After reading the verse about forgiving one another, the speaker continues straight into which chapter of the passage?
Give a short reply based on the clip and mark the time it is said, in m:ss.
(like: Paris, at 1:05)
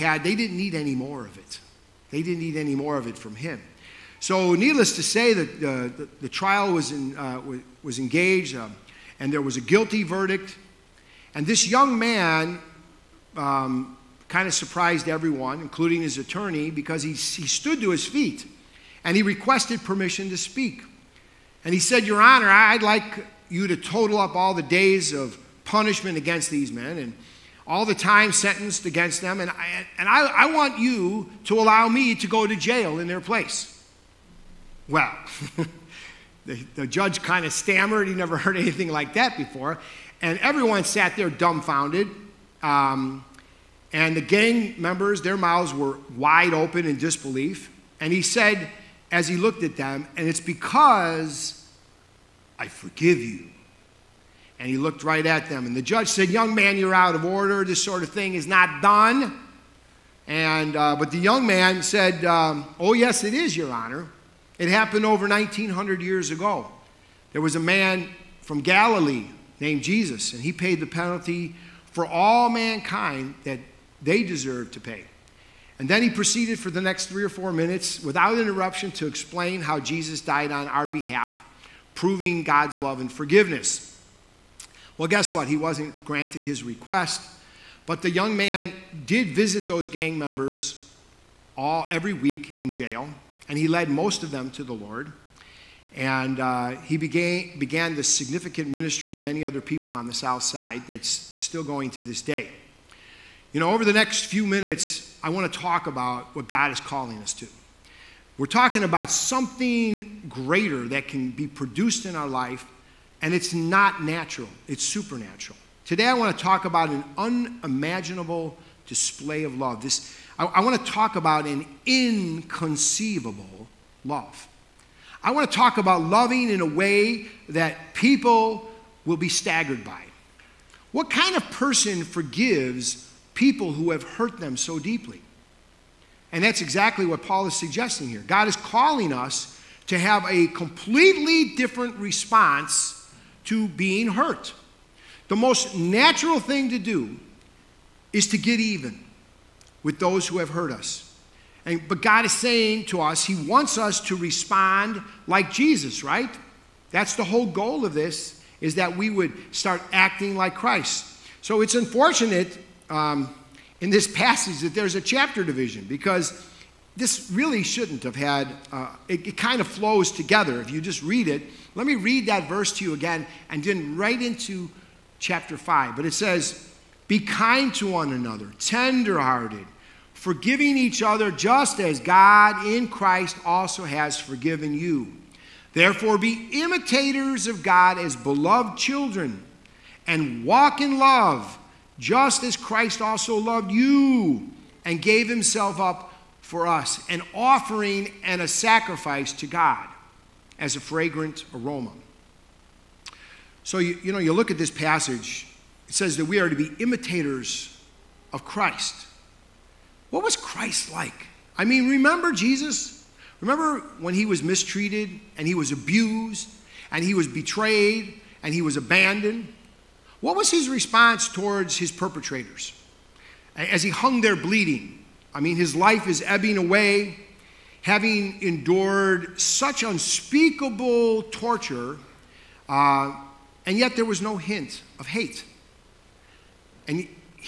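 Chapter 5, at 2:55.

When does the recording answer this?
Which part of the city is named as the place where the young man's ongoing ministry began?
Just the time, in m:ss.
1:40.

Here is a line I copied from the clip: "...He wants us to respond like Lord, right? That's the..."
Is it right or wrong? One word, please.
wrong.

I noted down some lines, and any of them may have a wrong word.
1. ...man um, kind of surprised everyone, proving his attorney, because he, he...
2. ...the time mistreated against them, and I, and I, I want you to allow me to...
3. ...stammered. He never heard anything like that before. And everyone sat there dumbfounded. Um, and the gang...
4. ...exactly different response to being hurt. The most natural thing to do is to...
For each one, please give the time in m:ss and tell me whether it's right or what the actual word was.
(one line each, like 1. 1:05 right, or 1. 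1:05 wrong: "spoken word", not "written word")
1. 0:11 wrong: "including", not "proving"
2. 0:27 wrong: "sentenced", not "mistreated"
3. 0:37 right
4. 2:20 wrong: "completely", not "exactly".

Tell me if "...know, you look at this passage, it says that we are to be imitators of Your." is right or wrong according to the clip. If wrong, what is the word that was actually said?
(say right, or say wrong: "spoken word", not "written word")
wrong: "Christ", not "Your".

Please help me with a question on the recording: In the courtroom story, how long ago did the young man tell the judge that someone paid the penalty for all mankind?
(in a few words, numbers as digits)
over 1900 years ago.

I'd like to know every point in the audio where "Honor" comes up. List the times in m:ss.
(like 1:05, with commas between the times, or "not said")
0:22, 1:03.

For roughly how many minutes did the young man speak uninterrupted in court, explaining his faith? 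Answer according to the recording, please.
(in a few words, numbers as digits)
3 or 4 minutes.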